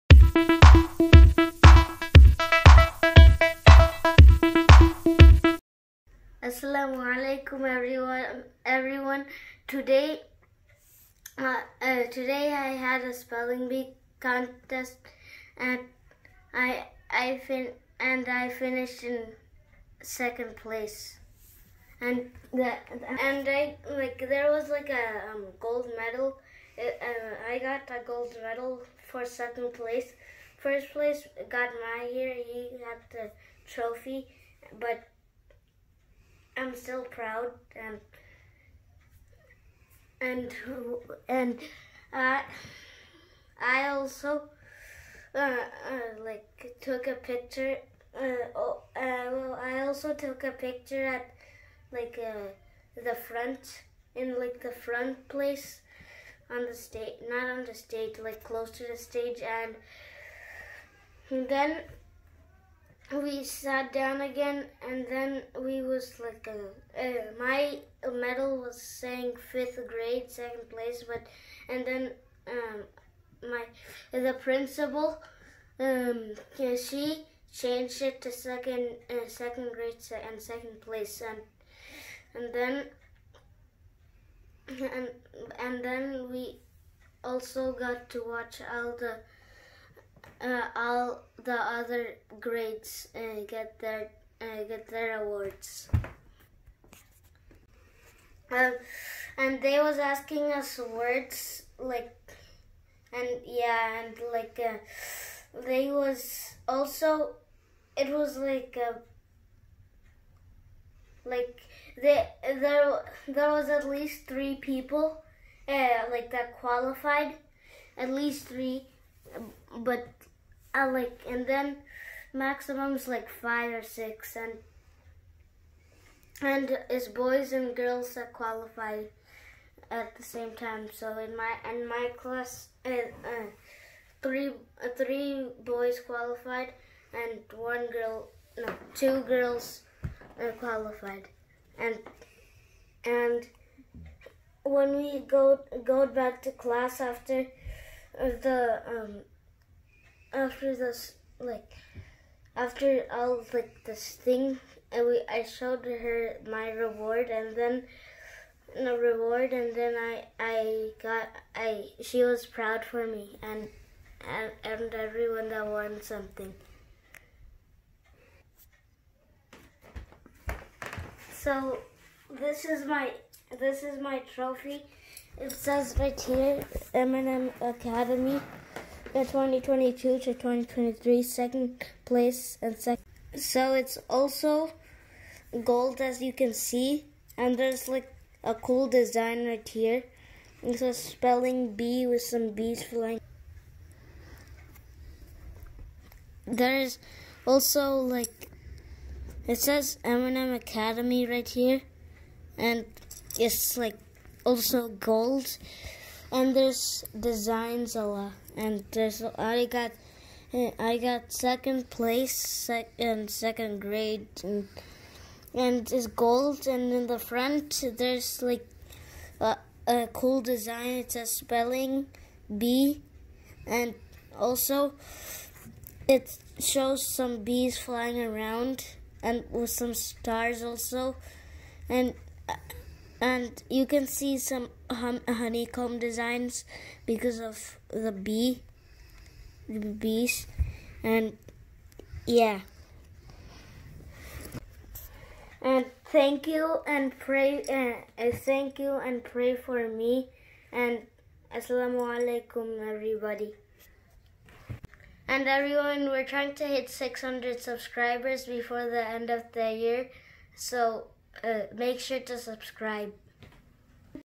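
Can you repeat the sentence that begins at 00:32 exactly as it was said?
he got the trophy but I'm still proud and and and I I also uh, uh, like took a picture.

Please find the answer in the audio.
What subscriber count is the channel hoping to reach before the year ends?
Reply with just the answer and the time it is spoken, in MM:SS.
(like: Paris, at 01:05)
600, at 04:16.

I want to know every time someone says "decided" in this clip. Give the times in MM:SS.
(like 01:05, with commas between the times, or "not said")
not said.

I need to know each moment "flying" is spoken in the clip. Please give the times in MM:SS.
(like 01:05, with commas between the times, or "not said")
03:12, 03:47.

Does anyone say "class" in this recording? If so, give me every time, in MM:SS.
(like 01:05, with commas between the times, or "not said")
02:12, 02:26.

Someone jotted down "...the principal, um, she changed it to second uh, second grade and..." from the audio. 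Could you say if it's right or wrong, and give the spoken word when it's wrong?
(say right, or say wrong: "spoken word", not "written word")
right.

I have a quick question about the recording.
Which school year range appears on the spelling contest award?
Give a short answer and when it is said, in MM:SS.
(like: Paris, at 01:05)
2022 to 2023, at 02:59.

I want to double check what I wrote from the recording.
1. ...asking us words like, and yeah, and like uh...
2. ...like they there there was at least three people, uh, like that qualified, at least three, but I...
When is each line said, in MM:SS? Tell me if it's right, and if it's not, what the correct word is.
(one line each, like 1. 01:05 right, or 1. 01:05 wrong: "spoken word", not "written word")
1. 01:39 right
2. 01:51 right.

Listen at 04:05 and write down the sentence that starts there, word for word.
And thank you and pray uh, thank you and pray for me and assalamu alaikum everybody.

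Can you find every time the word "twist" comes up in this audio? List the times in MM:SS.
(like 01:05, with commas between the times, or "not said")
not said.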